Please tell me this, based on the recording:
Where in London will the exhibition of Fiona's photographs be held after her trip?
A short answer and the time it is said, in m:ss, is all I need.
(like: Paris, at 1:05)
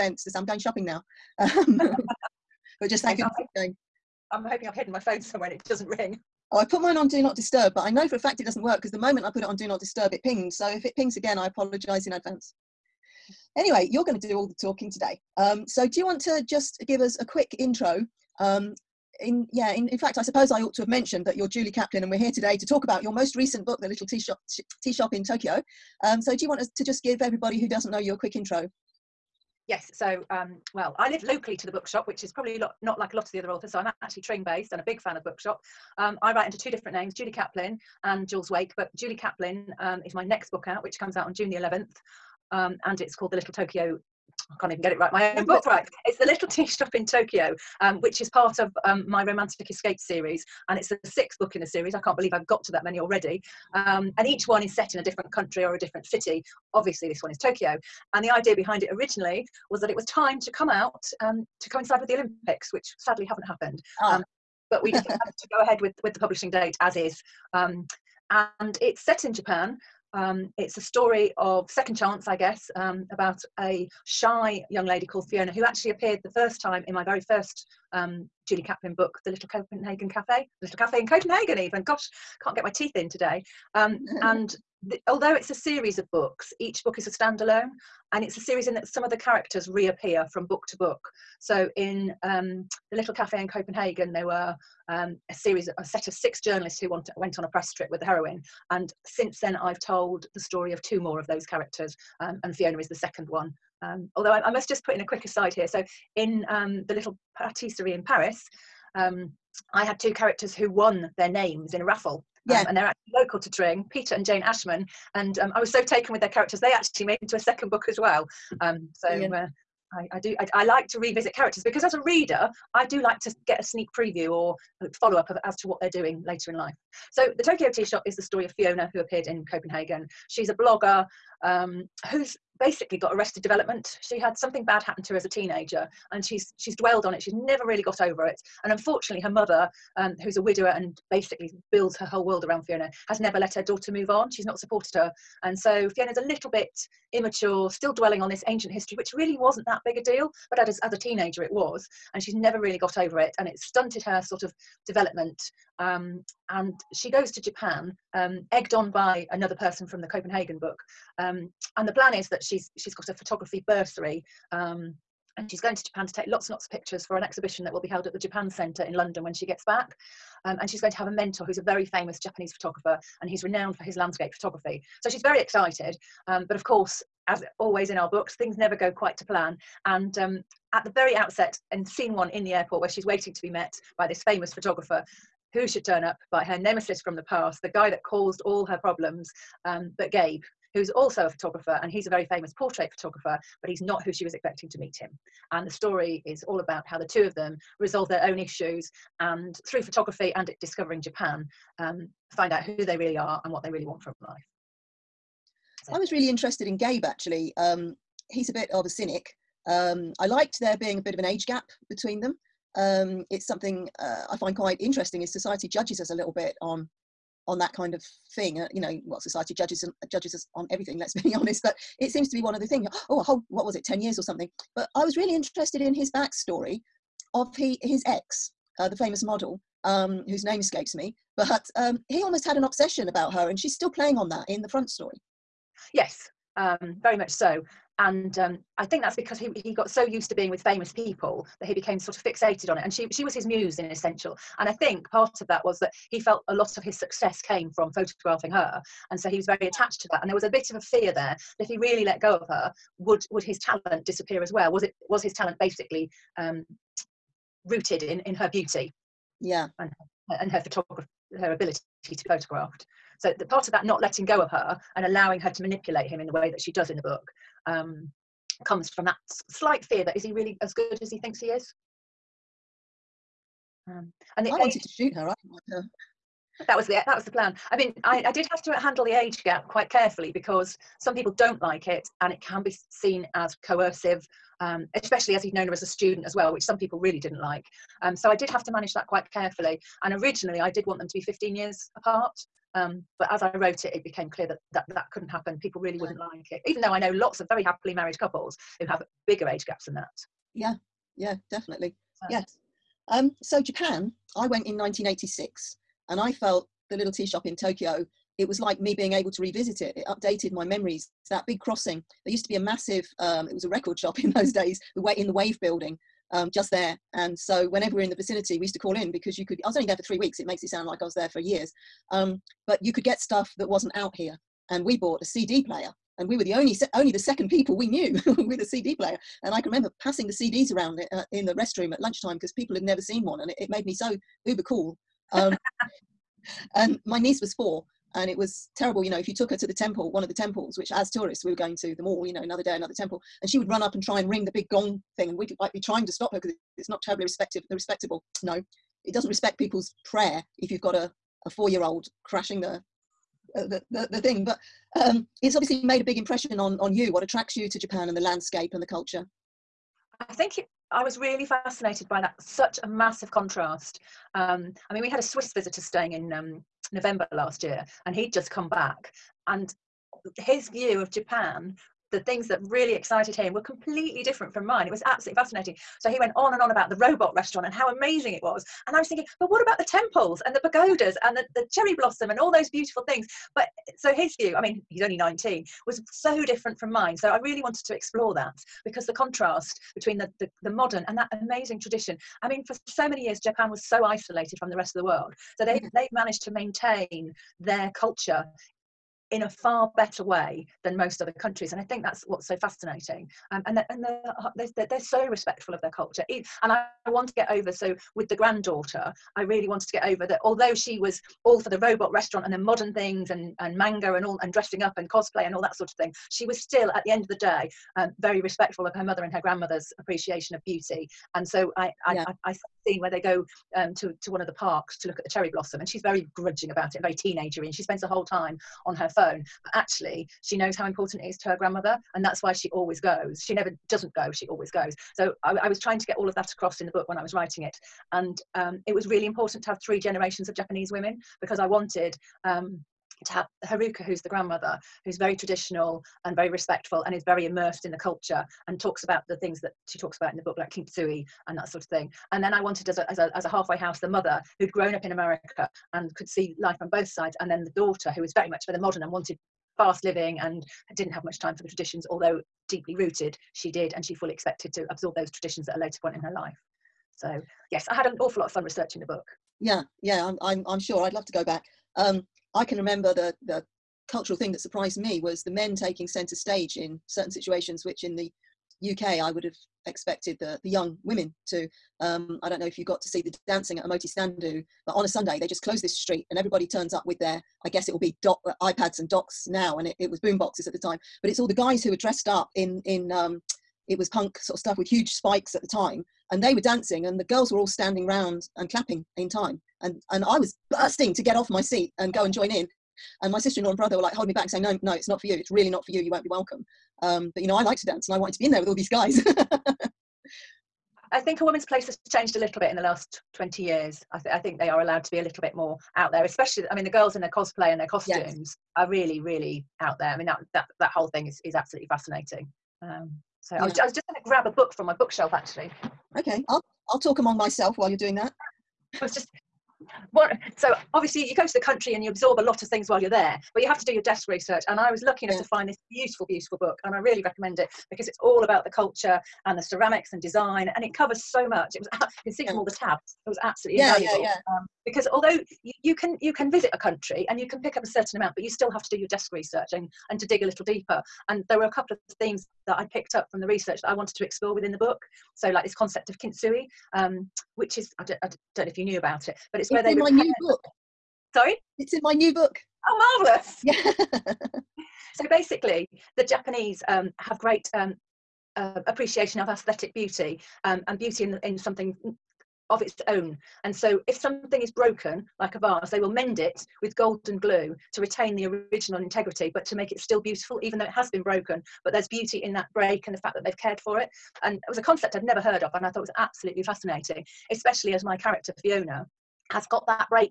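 Japan Centre, at 2:48.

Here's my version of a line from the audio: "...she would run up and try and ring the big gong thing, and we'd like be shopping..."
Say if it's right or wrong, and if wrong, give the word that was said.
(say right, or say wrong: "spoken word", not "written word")
wrong: "trying", not "shopping".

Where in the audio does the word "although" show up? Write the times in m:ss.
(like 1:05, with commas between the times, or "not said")
1:25, 1:44, 6:50, 7:42, 9:05.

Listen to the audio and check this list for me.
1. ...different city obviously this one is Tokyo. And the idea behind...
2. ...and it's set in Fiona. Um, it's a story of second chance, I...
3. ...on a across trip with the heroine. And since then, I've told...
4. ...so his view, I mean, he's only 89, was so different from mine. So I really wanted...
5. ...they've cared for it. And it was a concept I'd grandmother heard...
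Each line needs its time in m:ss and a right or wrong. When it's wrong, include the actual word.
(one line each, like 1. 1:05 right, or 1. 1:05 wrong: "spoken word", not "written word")
1. 0:55 right
2. 1:08 wrong: "Japan", not "Fiona"
3. 1:37 wrong: "press", not "across"
4. 6:23 wrong: "19", not "89"
5. 9:43 wrong: "never", not "grandmother".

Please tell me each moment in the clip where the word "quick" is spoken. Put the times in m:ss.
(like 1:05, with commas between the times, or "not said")
0:17, 0:28, 1:45.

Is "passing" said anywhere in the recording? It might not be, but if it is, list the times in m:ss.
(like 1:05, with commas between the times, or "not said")
5:30.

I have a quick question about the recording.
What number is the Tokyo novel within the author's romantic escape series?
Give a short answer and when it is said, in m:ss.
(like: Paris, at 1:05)
6th, at 0:51.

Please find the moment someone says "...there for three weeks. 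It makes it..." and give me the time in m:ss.
5:19.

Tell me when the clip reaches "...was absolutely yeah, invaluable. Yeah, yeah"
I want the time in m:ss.
9:03.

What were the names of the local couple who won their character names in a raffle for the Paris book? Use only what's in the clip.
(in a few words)
Peter and Jane Ashman.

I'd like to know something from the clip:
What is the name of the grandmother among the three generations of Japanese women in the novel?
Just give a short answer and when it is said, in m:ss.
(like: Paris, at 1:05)
Haruka, at 7:23.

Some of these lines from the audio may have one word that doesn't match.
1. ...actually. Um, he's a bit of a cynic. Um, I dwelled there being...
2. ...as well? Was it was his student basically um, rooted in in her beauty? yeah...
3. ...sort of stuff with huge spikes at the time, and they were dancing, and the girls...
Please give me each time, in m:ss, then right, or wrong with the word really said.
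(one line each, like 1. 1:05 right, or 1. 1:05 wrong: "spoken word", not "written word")
1. 3:27 wrong: "liked", not "dwelled"
2. 4:14 wrong: "talent", not "student"
3. 8:14 right.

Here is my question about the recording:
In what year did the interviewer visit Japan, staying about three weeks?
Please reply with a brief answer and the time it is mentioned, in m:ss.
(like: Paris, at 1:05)
1986, at 5:04.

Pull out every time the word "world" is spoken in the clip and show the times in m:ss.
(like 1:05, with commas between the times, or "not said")
2:22, 6:35.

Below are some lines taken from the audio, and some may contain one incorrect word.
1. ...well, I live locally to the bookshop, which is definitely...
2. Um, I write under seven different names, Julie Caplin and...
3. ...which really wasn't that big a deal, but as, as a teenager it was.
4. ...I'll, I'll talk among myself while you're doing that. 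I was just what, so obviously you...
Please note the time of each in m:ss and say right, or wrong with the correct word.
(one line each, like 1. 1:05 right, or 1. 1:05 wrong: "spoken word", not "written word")
1. 0:30 wrong: "probably", not "definitely"
2. 0:35 wrong: "two", not "seven"
3. 2:28 right
4. 8:46 right.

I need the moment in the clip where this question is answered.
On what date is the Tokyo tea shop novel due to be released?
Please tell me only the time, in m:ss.
0:41.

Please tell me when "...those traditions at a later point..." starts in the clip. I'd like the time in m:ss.
7:45.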